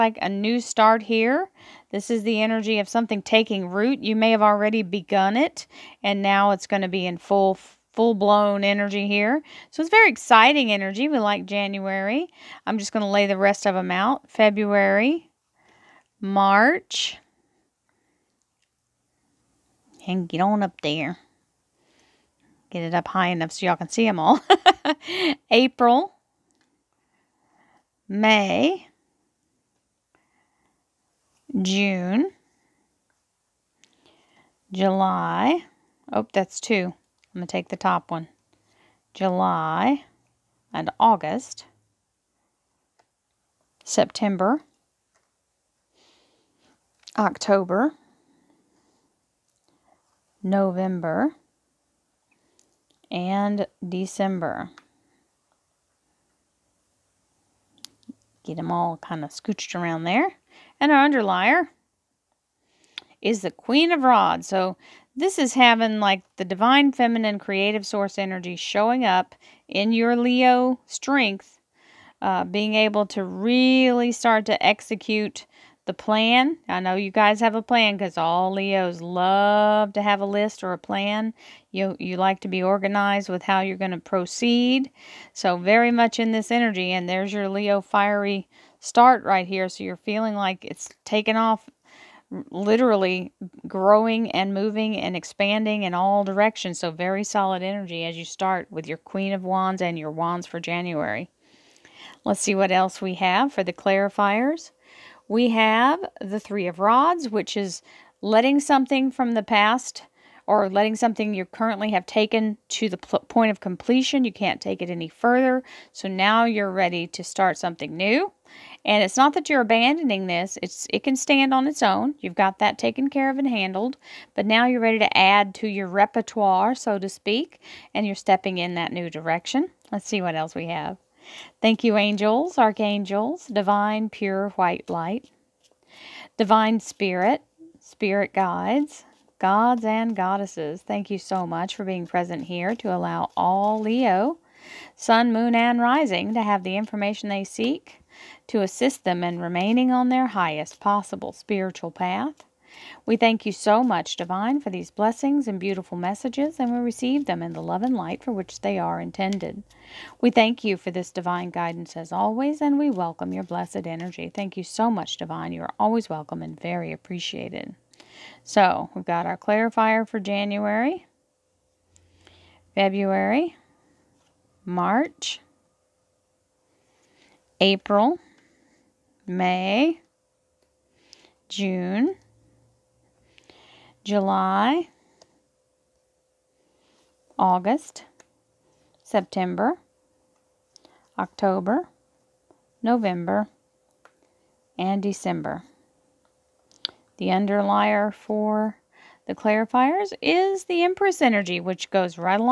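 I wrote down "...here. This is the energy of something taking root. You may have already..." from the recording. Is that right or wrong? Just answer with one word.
right.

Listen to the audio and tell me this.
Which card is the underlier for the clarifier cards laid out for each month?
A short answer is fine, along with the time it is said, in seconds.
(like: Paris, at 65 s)
The Empress, at 200 s.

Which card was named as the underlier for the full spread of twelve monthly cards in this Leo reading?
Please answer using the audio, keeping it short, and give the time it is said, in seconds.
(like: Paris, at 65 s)
Queen of Rods, at 63 s.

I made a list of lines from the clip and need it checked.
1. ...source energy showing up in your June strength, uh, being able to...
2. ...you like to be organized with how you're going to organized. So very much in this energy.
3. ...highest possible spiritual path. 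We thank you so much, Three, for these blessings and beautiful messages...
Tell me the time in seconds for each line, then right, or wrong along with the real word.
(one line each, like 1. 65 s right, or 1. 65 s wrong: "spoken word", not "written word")
1. 67 s wrong: "Leo", not "June"
2. 81 s wrong: "proceed", not "organized"
3. 150 s wrong: "Divine", not "Three".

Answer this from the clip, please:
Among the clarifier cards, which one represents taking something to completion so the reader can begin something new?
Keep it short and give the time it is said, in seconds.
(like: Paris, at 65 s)
Three of Rods, at 106 s.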